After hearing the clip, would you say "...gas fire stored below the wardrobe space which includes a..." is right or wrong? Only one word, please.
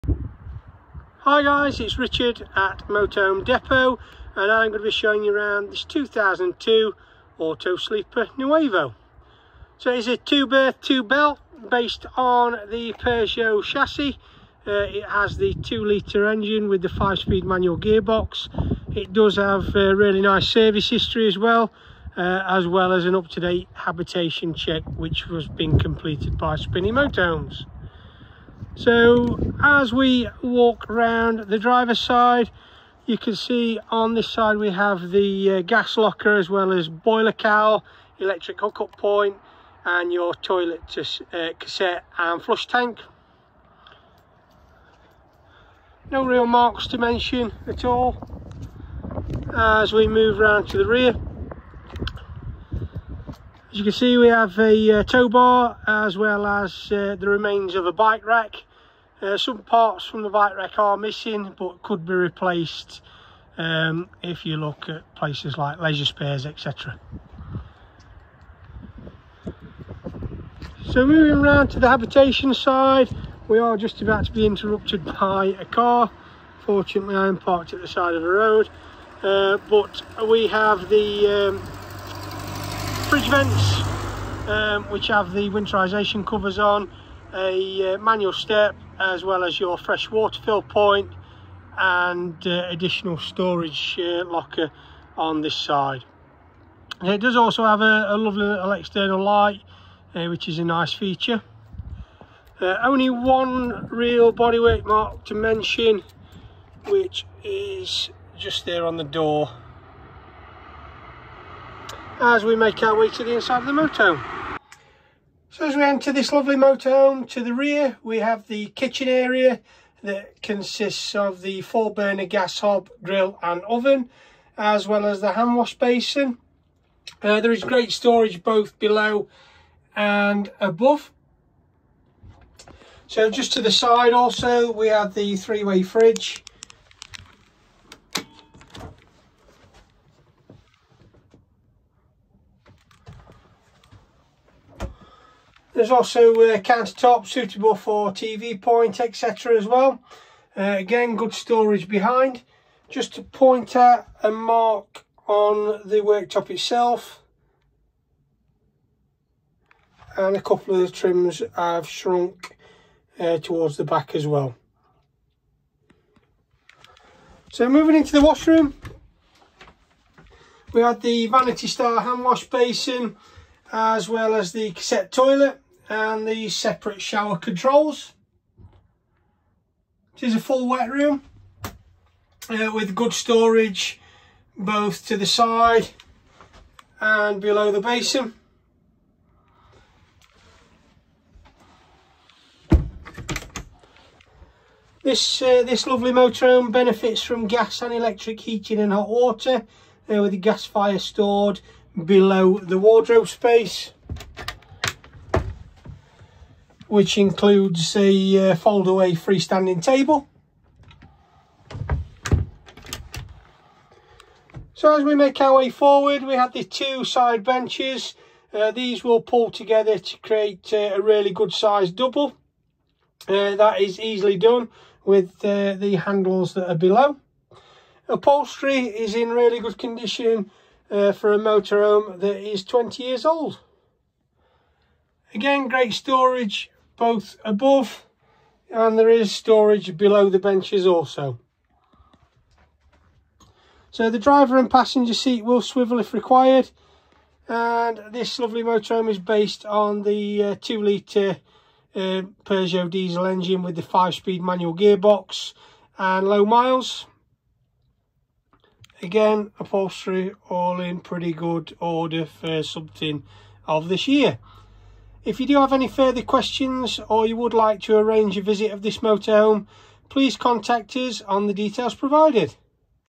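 right.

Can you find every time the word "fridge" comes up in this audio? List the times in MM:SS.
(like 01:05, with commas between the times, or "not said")
01:23, 02:15.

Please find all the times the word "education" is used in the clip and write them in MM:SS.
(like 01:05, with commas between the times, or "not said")
not said.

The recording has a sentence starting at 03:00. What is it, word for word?
This is a full wet room uh, with good storage both to the side and below the basin.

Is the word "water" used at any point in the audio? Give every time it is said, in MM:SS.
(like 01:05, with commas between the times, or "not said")
01:30, 03:19.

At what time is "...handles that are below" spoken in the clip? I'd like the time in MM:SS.
03:45.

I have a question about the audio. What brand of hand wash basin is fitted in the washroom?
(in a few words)
Vanity Star.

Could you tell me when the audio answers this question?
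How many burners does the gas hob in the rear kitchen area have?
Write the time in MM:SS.
02:01.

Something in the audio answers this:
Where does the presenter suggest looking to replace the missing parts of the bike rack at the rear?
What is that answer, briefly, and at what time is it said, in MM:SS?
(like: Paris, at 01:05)
Leisure Spares, at 01:05.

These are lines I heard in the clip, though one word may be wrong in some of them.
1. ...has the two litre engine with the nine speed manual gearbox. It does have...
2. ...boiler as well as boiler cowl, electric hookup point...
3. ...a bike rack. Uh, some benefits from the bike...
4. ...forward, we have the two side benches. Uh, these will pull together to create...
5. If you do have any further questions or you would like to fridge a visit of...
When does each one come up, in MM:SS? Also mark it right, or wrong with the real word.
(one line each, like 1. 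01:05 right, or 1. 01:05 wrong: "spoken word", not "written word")
1. 00:15 wrong: "five", not "nine"
2. 00:35 wrong: "locker", not "boiler"
3. 00:57 wrong: "parts", not "benefits"
4. 03:35 right
5. 04:25 wrong: "arrange", not "fridge".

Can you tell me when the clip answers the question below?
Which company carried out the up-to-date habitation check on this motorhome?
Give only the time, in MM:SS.
00:26.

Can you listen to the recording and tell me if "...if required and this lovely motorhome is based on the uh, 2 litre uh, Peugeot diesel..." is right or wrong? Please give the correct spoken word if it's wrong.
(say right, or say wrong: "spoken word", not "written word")
right.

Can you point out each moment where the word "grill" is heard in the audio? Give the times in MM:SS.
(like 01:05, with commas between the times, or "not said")
02:03.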